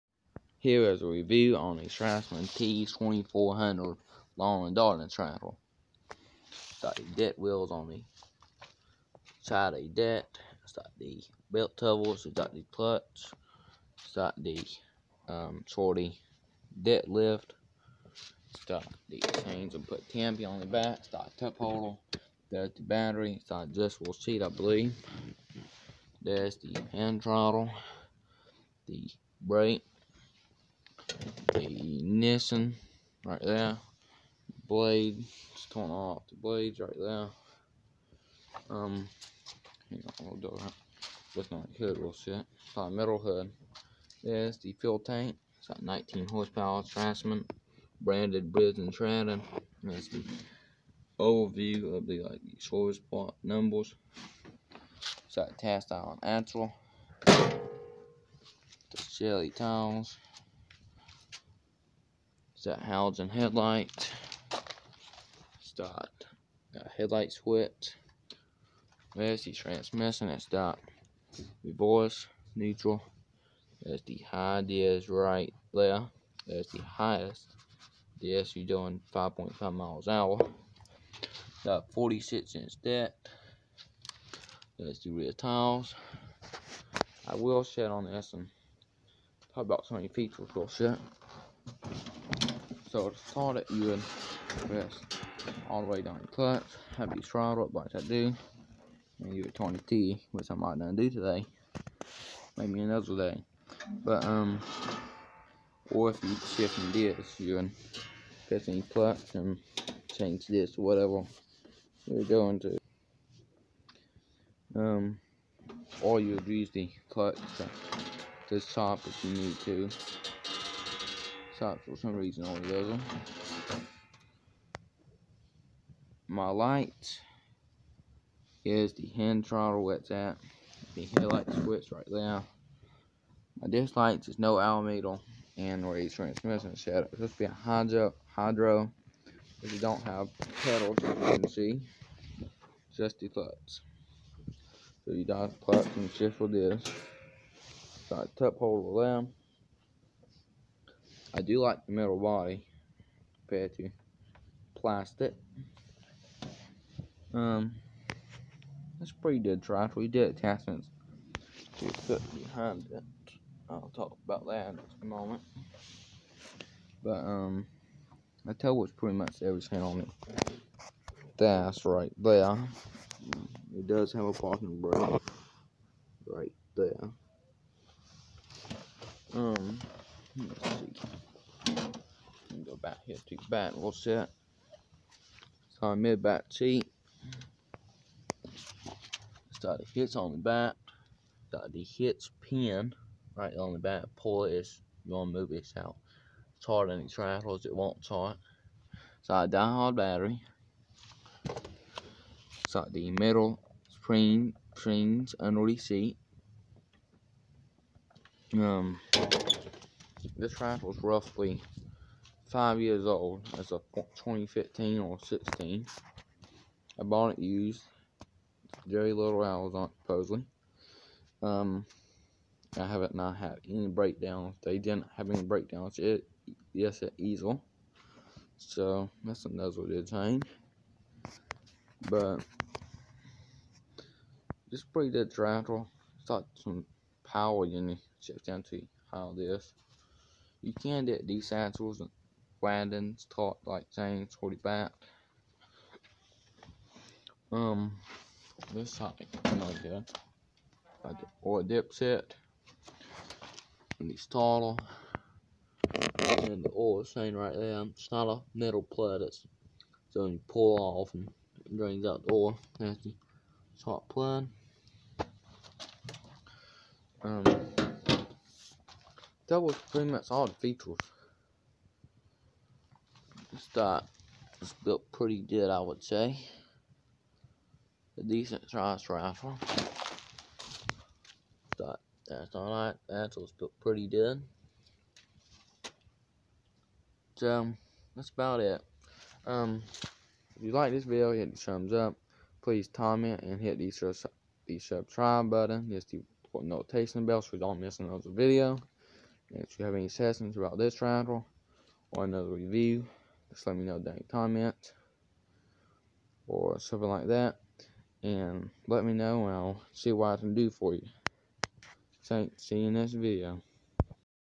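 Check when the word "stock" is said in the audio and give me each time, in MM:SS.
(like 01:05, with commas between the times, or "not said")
04:33, 04:41.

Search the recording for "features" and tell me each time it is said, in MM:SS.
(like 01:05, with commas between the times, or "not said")
01:30, 04:30.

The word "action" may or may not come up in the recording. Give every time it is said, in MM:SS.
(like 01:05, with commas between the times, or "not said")
not said.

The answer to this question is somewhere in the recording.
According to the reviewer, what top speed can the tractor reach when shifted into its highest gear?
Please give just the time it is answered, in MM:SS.
01:19.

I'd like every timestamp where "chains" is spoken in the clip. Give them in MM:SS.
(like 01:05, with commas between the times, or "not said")
00:19, 04:03.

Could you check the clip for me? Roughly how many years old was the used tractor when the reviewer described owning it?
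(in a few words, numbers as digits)
5.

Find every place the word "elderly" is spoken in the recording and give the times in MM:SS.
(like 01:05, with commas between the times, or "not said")
not said.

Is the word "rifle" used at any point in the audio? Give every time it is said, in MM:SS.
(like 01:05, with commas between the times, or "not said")
04:39, 05:01.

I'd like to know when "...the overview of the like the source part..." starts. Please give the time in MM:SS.
00:50.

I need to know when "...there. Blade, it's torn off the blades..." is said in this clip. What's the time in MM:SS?
00:33.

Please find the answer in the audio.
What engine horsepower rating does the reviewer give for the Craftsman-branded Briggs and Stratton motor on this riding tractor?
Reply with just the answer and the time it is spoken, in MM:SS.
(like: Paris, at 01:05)
19, at 00:45.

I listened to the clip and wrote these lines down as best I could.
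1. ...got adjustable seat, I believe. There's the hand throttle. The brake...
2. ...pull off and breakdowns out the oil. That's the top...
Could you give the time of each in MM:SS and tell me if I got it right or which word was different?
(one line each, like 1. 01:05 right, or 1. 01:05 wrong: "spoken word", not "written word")
1. 00:23 right
2. 04:20 wrong: "drains", not "breakdowns".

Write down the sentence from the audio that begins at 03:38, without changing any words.
Very little hours on it, supposedly.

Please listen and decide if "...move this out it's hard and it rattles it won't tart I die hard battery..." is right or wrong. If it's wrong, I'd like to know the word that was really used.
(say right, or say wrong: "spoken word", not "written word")
right.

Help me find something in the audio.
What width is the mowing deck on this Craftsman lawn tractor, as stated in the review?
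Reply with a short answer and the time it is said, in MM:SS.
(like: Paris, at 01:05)
46 inch, at 01:21.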